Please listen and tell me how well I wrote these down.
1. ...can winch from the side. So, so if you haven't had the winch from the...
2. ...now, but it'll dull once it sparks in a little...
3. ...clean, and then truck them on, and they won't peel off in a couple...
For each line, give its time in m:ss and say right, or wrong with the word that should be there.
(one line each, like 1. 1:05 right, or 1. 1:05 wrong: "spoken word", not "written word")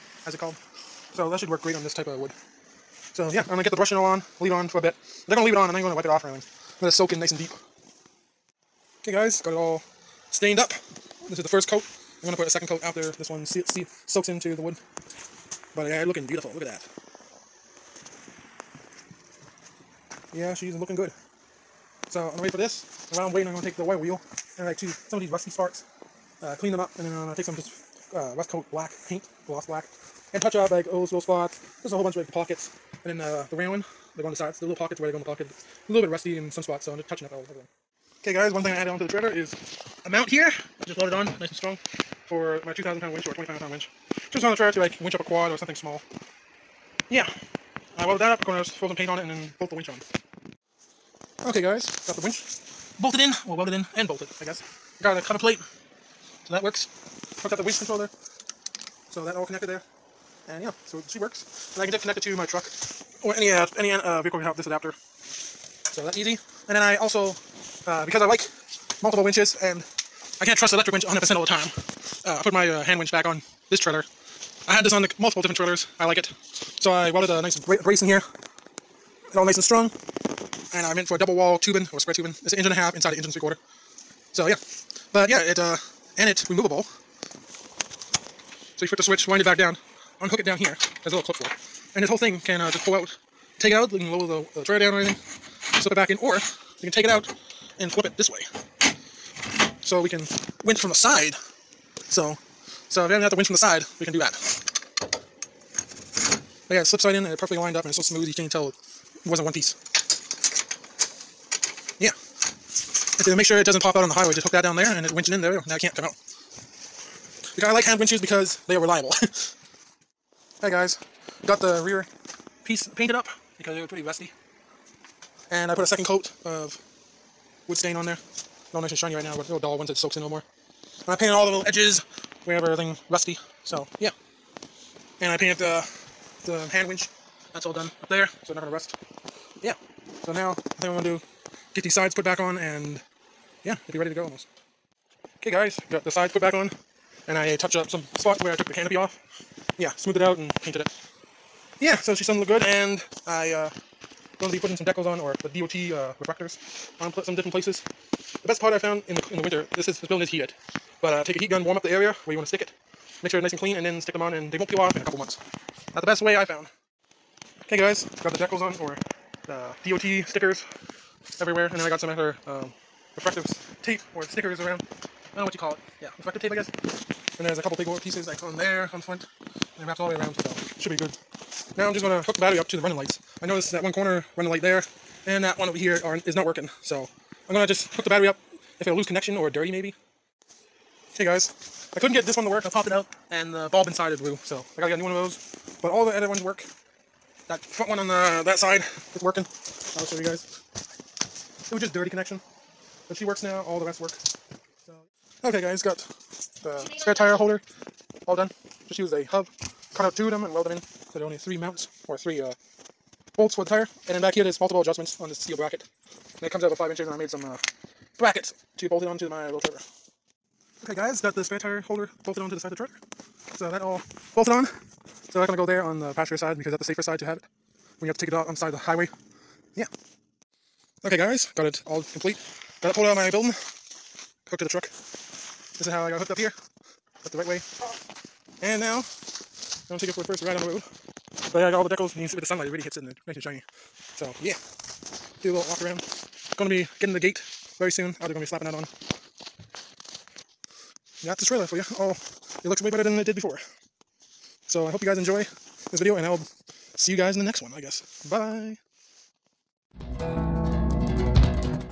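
1. 1:40 right
2. 2:09 wrong: "soaks", not "sparks"
3. 2:43 wrong: "stick", not "truck".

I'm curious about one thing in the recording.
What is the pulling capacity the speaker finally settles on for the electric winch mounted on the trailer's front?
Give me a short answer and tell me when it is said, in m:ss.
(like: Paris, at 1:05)
2,500 pounds, at 0:43.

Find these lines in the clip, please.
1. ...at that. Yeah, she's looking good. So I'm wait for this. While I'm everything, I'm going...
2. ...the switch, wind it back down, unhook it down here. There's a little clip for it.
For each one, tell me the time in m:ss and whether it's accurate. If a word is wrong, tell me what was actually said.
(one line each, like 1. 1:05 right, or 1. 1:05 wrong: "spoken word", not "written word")
1. 0:16 wrong: "waiting", not "everything"
2. 1:28 right.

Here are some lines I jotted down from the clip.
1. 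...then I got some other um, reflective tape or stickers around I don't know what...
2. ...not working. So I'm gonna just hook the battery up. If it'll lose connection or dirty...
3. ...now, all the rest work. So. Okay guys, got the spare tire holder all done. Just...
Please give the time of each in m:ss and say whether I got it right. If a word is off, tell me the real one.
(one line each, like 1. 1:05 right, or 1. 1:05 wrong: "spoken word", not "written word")
1. 2:51 right
2. 3:06 right
3. 3:23 right.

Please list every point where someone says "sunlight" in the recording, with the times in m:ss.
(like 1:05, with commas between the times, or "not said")
4:02.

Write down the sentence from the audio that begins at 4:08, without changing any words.
Oh, they're gonna be slapping that on.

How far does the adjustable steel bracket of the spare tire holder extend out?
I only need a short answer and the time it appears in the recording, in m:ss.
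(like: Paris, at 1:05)
About 5 inches, at 3:36.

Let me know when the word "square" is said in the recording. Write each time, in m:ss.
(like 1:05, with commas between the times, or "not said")
1:21.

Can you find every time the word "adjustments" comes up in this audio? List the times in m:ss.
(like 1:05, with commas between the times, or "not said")
3:34.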